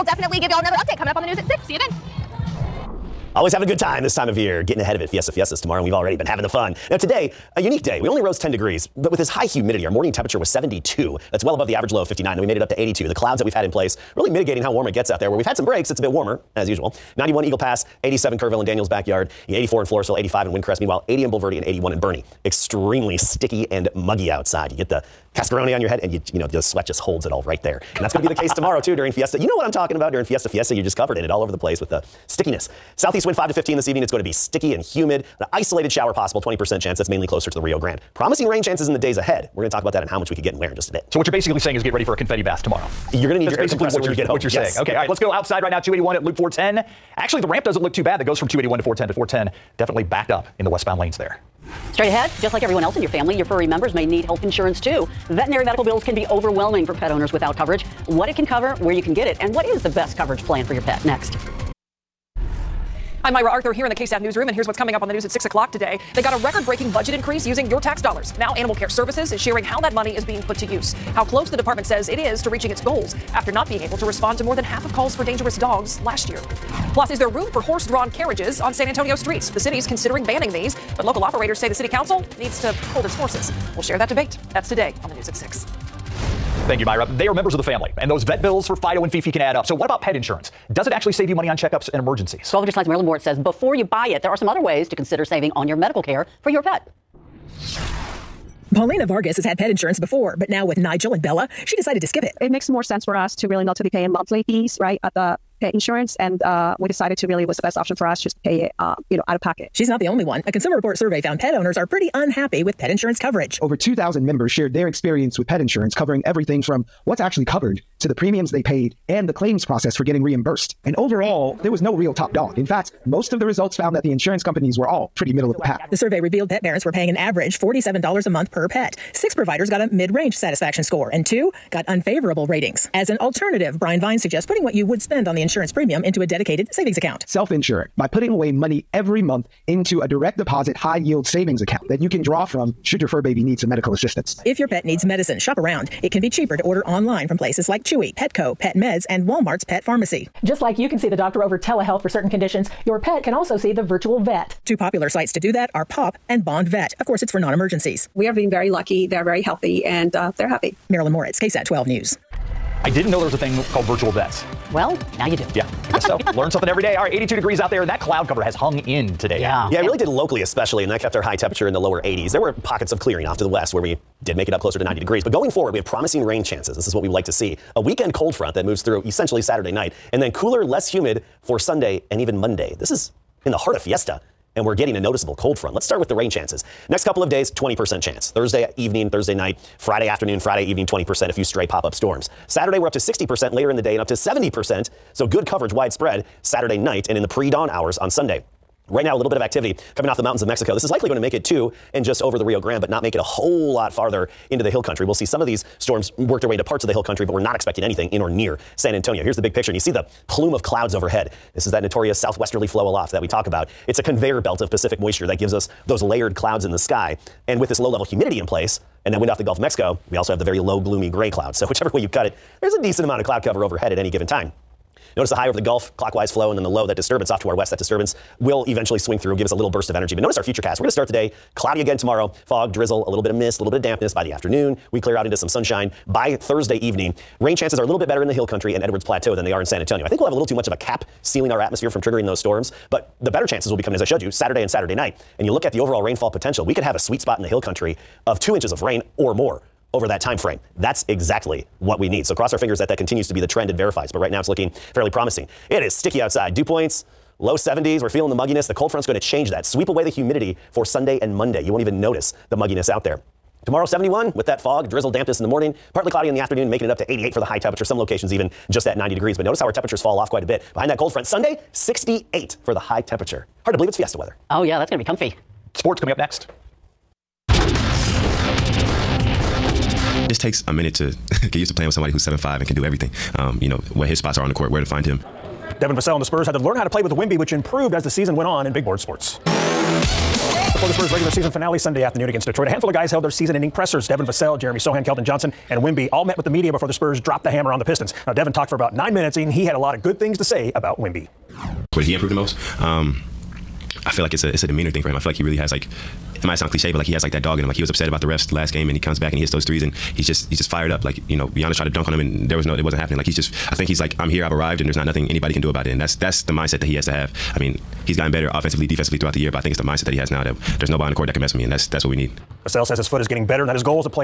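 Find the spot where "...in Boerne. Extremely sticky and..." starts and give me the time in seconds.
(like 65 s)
21 s.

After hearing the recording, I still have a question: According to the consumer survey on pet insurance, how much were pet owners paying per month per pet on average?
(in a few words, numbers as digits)
$47.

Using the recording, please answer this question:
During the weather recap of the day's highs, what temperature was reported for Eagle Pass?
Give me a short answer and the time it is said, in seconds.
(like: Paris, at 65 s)
91, at 17 s.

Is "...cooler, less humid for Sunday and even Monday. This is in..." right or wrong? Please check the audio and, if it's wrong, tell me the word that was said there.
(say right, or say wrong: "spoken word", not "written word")
right.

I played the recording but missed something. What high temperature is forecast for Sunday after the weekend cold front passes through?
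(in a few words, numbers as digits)
68.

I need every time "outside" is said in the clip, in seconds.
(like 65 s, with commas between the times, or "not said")
24 s, 45 s, 256 s.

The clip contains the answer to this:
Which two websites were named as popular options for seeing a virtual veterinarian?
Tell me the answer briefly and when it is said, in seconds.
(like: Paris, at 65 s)
Pawp and Bond Vet, at 155 s.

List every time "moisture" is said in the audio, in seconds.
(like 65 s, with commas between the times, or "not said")
214 s.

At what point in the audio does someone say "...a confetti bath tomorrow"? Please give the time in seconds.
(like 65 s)
42 s.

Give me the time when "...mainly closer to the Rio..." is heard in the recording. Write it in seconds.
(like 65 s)
37 s.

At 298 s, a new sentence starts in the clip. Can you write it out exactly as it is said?
Now, Devin talked for about nine minutes, and he had a lot of good things to say about Wemby.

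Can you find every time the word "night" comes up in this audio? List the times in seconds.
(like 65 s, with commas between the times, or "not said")
179 s, 189 s, 196 s, 244 s.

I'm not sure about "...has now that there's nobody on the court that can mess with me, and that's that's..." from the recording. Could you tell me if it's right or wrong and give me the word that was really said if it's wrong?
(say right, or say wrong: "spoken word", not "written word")
right.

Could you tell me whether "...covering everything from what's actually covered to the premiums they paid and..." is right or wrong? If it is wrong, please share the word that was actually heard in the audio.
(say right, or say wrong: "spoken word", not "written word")
right.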